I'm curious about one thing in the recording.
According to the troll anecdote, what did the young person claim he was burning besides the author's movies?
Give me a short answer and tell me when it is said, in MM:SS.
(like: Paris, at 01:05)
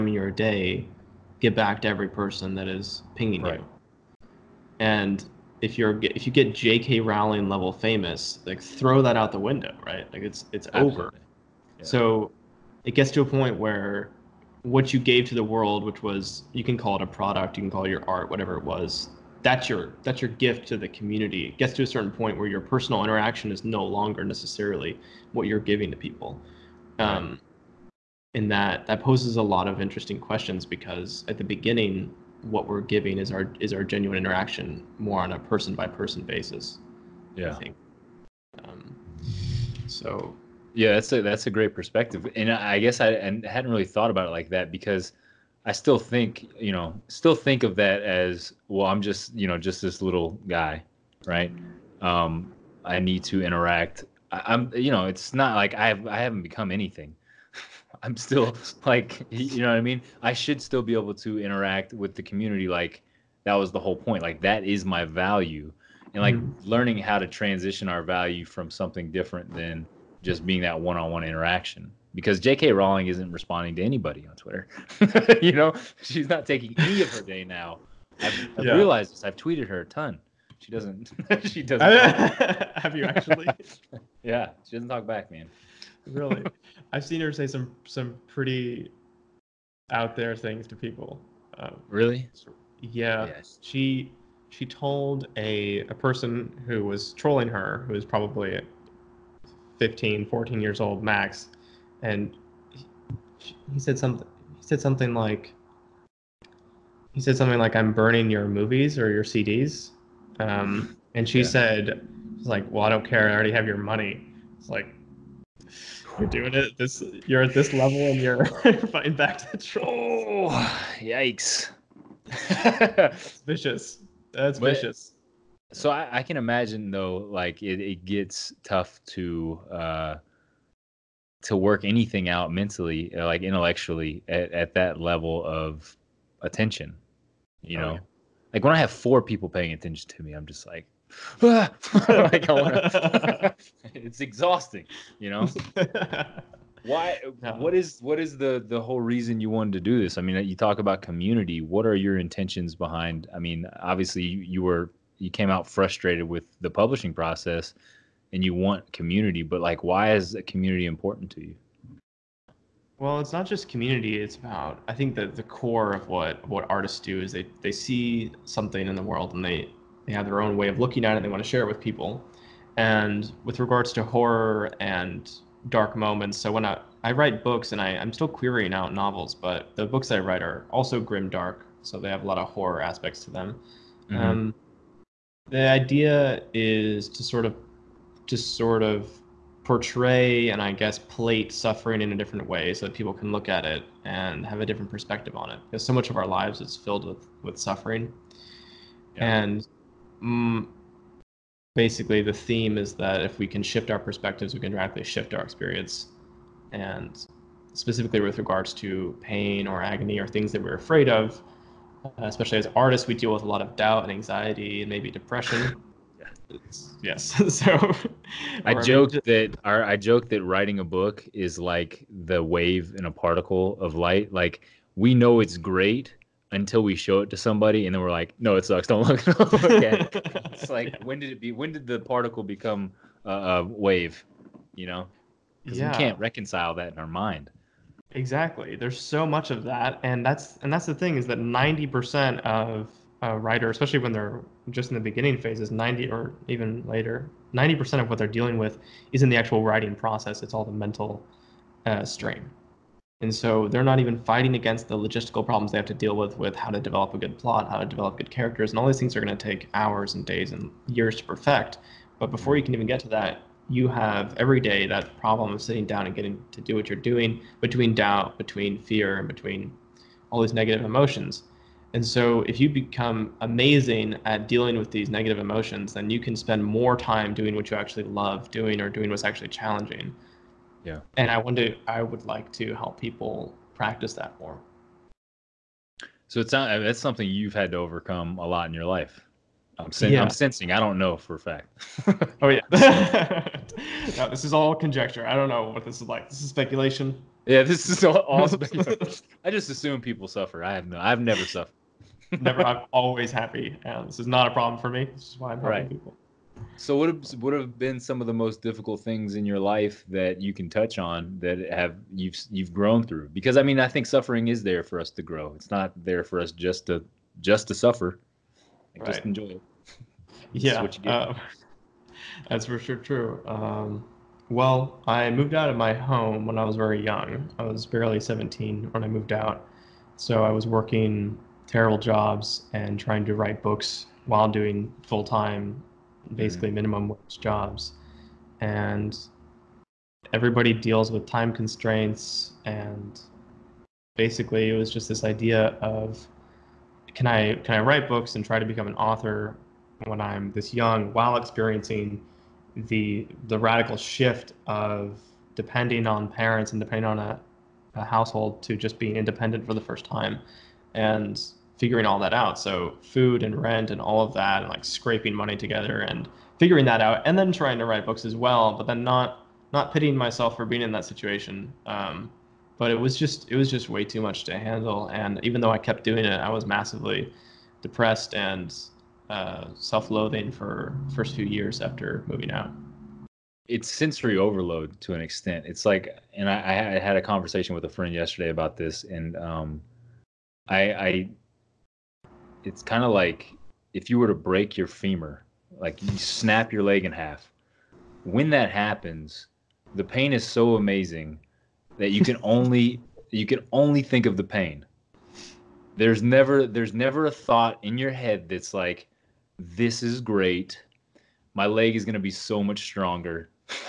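CDs, at 01:49.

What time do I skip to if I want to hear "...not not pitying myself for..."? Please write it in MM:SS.
06:09.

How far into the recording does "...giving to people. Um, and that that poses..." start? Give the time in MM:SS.
00:25.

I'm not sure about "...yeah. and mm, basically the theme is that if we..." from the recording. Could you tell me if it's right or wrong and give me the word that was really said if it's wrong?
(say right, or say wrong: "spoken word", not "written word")
right.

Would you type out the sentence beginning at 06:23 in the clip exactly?
It's sensory overload to an extent.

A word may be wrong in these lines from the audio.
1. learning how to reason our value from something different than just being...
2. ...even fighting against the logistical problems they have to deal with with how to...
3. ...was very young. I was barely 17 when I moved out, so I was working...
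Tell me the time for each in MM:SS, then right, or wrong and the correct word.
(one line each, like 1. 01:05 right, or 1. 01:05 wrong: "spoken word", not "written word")
1. 01:06 wrong: "transition", not "reason"
2. 04:14 right
3. 05:26 right.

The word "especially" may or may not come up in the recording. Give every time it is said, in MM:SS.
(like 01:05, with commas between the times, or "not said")
03:32, 04:03.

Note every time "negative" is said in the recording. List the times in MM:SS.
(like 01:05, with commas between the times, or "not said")
04:30, 04:35.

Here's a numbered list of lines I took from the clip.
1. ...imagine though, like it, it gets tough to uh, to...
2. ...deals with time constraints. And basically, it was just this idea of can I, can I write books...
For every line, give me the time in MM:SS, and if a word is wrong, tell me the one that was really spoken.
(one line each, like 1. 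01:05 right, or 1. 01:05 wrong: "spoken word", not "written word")
1. 02:06 right
2. 05:40 right.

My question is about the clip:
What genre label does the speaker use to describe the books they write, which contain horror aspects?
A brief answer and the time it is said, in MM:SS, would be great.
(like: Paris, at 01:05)
grim dark, at 03:00.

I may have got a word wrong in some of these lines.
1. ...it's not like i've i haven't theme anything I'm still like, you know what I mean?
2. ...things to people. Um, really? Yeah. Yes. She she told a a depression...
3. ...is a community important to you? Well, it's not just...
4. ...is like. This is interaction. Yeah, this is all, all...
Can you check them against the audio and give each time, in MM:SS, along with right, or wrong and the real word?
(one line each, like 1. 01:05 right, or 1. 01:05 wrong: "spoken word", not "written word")
1. 00:55 wrong: "become", not "theme"
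2. 01:30 wrong: "person", not "depression"
3. 02:40 right
4. 04:55 wrong: "speculation", not "interaction".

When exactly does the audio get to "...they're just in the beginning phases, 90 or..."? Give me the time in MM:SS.
04:04.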